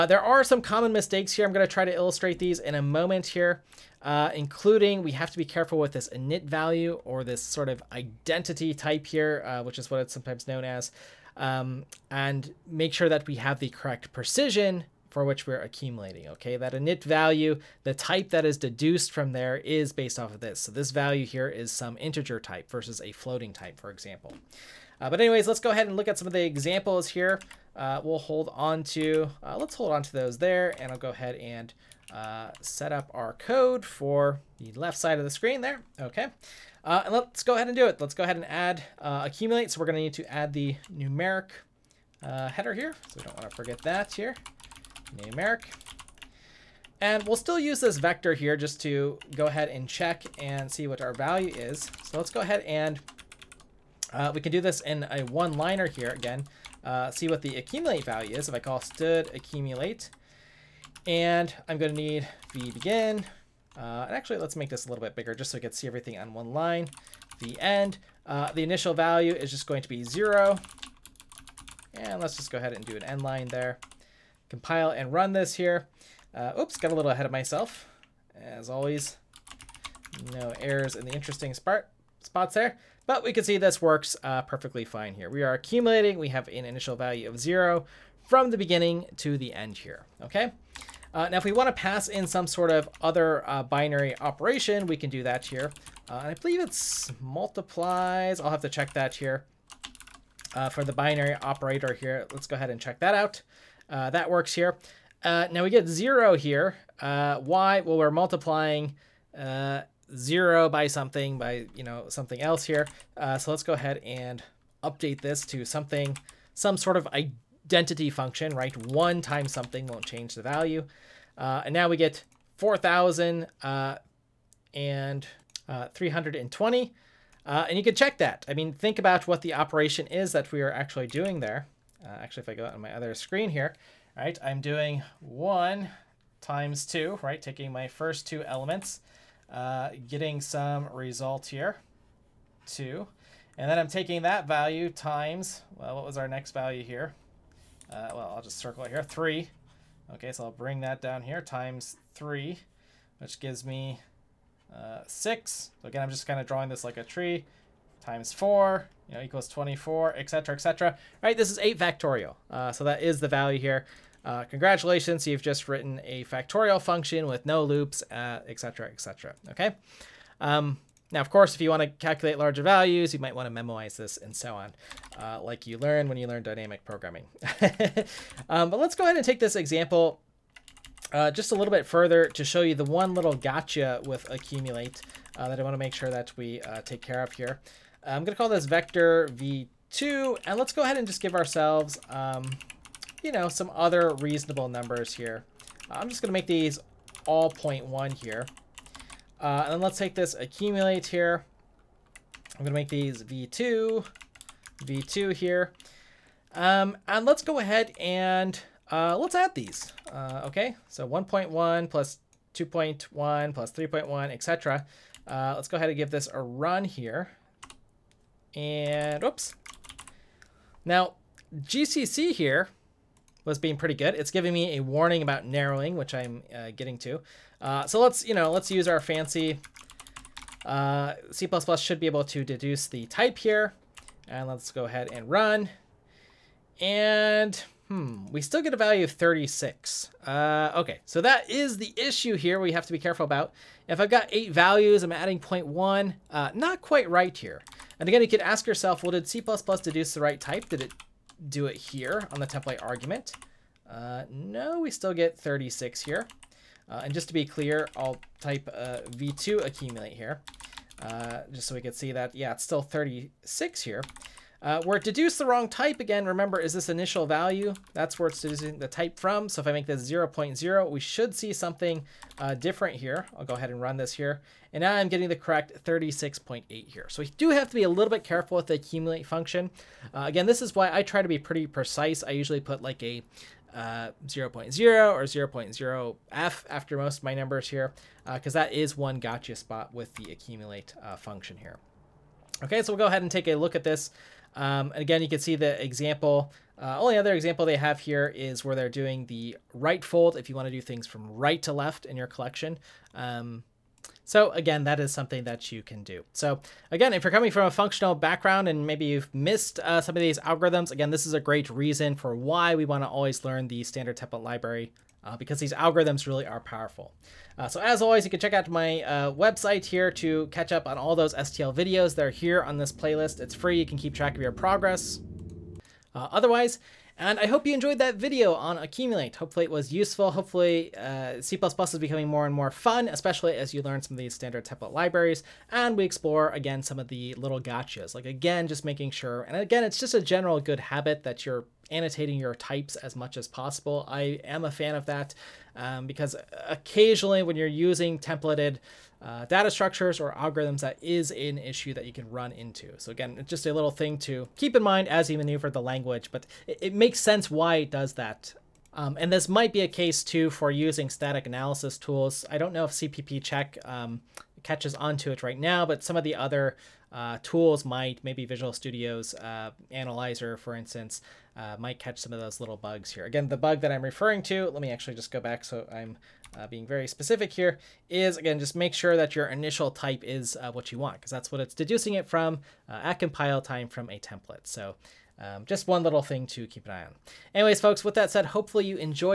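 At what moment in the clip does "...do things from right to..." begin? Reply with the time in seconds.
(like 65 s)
300 s.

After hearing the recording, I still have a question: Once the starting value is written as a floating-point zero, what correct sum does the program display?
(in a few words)
36.8.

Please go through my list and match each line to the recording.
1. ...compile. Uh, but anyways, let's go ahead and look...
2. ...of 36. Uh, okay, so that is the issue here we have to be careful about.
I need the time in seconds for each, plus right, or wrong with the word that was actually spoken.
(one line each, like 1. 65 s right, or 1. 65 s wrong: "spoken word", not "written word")
1. 23 s wrong: "example", not "compile"
2. 239 s right.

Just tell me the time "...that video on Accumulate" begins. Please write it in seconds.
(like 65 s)
327 s.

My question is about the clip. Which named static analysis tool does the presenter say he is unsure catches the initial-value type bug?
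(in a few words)
CPP check.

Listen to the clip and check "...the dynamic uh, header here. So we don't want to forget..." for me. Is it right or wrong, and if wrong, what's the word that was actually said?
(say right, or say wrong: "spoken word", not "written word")
wrong: "numeric", not "dynamic".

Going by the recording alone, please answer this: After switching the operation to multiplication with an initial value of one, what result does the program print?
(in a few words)
40320.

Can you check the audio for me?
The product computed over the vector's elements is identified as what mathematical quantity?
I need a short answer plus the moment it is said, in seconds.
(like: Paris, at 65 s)
8 factorial, at 161 s.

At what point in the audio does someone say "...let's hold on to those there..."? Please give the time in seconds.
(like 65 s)
29 s.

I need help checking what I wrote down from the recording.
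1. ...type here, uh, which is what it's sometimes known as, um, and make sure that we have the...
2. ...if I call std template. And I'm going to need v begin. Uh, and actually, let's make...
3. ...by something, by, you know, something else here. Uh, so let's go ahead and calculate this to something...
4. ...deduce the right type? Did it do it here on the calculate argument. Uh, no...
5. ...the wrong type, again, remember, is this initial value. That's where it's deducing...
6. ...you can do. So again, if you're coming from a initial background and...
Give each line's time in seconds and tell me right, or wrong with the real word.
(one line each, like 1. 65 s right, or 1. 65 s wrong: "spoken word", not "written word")
1. 8 s right
2. 58 s wrong: "accumulate", not "template"
3. 110 s wrong: "update", not "calculate"
4. 249 s wrong: "template", not "calculate"
5. 265 s right
6. 305 s wrong: "functional", not "initial".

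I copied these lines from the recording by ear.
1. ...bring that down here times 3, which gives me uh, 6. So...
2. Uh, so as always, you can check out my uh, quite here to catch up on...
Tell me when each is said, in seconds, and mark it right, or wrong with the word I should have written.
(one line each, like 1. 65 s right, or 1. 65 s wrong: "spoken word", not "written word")
1. 150 s right
2. 317 s wrong: "website", not "quite".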